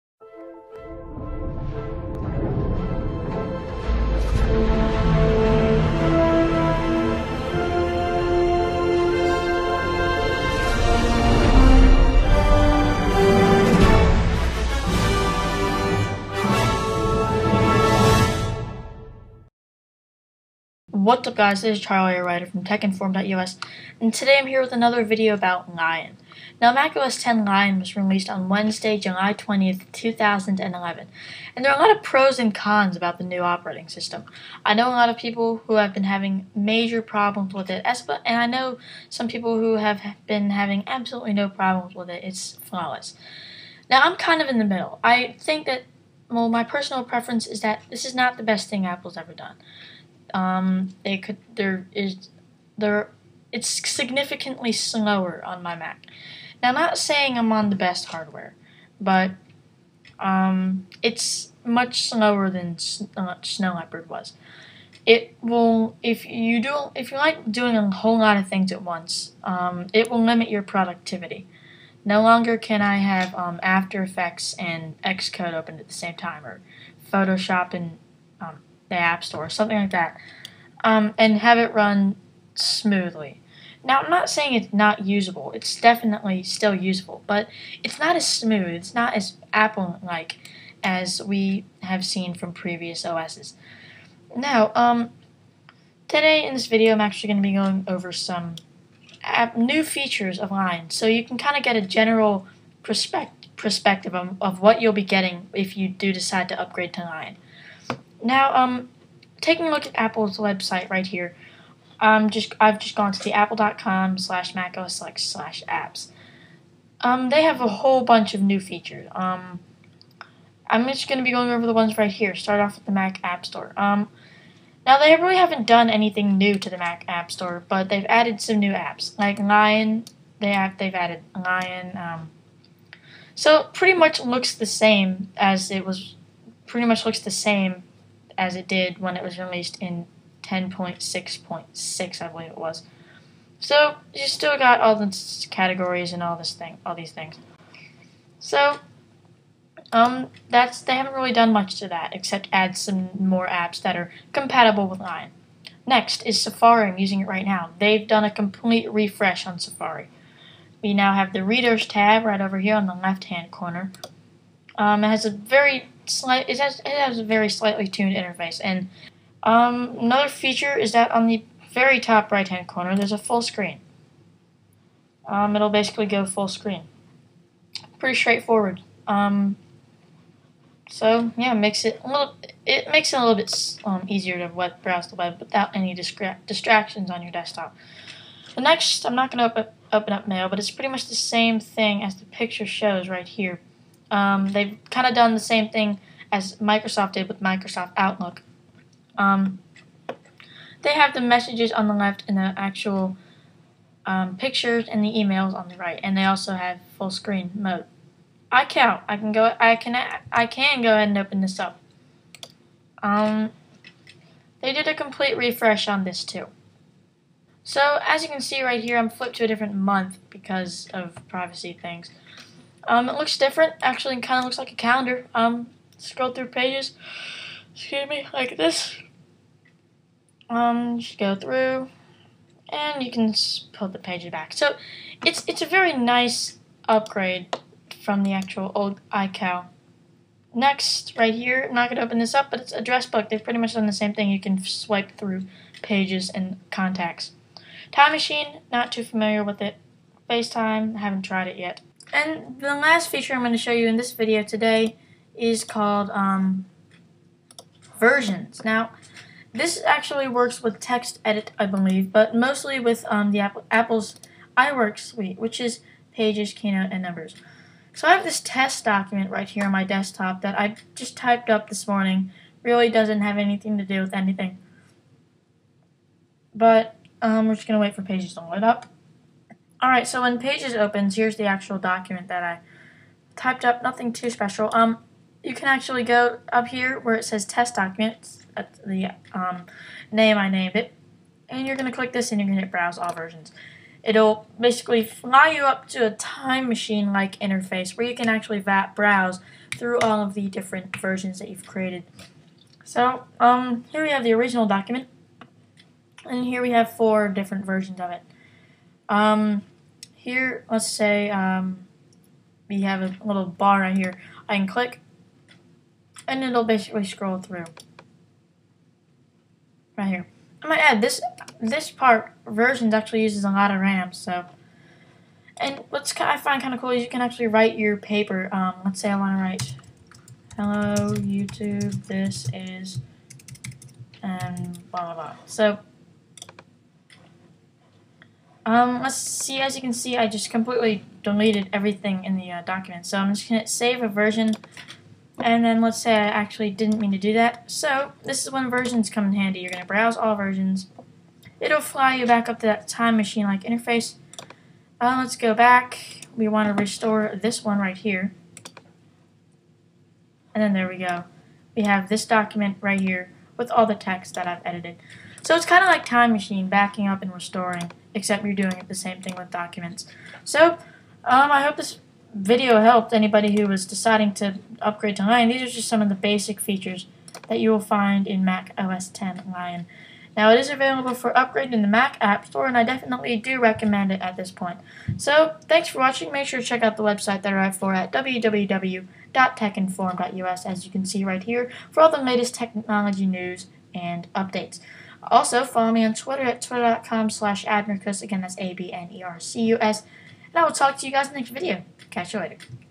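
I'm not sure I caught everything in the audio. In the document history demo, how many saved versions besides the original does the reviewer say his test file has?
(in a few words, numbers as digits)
4.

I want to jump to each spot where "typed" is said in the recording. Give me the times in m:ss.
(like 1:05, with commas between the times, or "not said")
4:31, 4:43.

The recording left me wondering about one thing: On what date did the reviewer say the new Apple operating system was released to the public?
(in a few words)
July 20th, 2011.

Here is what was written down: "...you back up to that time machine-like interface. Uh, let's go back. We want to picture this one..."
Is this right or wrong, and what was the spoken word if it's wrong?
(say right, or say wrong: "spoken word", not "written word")
wrong: "restore", not "picture".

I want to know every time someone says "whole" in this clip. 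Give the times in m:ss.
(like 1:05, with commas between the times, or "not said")
1:07, 1:57.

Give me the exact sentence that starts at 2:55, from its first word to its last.
Um, it'll basically go full screen.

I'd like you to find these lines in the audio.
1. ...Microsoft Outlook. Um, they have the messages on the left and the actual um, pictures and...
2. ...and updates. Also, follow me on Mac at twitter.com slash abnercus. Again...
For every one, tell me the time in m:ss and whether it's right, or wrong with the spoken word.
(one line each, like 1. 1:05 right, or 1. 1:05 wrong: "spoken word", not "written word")
1. 3:17 right
2. 6:33 wrong: "Twitter", not "Mac".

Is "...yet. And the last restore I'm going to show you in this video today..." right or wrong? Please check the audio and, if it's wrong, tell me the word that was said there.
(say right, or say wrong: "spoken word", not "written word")
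wrong: "feature", not "restore".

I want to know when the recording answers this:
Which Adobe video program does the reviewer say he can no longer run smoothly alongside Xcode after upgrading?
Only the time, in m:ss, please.
1:13.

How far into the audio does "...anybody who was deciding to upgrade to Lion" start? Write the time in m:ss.
6:13.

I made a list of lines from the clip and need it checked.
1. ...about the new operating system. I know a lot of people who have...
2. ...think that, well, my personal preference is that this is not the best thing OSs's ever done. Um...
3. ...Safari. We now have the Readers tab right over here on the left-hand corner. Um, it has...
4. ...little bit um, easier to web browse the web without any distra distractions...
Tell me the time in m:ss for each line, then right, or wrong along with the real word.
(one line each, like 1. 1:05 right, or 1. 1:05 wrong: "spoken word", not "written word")
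1. 0:32 right
2. 0:45 wrong: "Apple", not "OSs"
3. 2:39 right
4. 3:03 right.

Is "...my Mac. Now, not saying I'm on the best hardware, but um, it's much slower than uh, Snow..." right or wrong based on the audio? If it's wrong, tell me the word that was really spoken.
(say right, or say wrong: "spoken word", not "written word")
right.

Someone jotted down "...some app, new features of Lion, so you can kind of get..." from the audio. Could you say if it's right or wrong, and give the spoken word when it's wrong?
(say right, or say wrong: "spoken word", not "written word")
right.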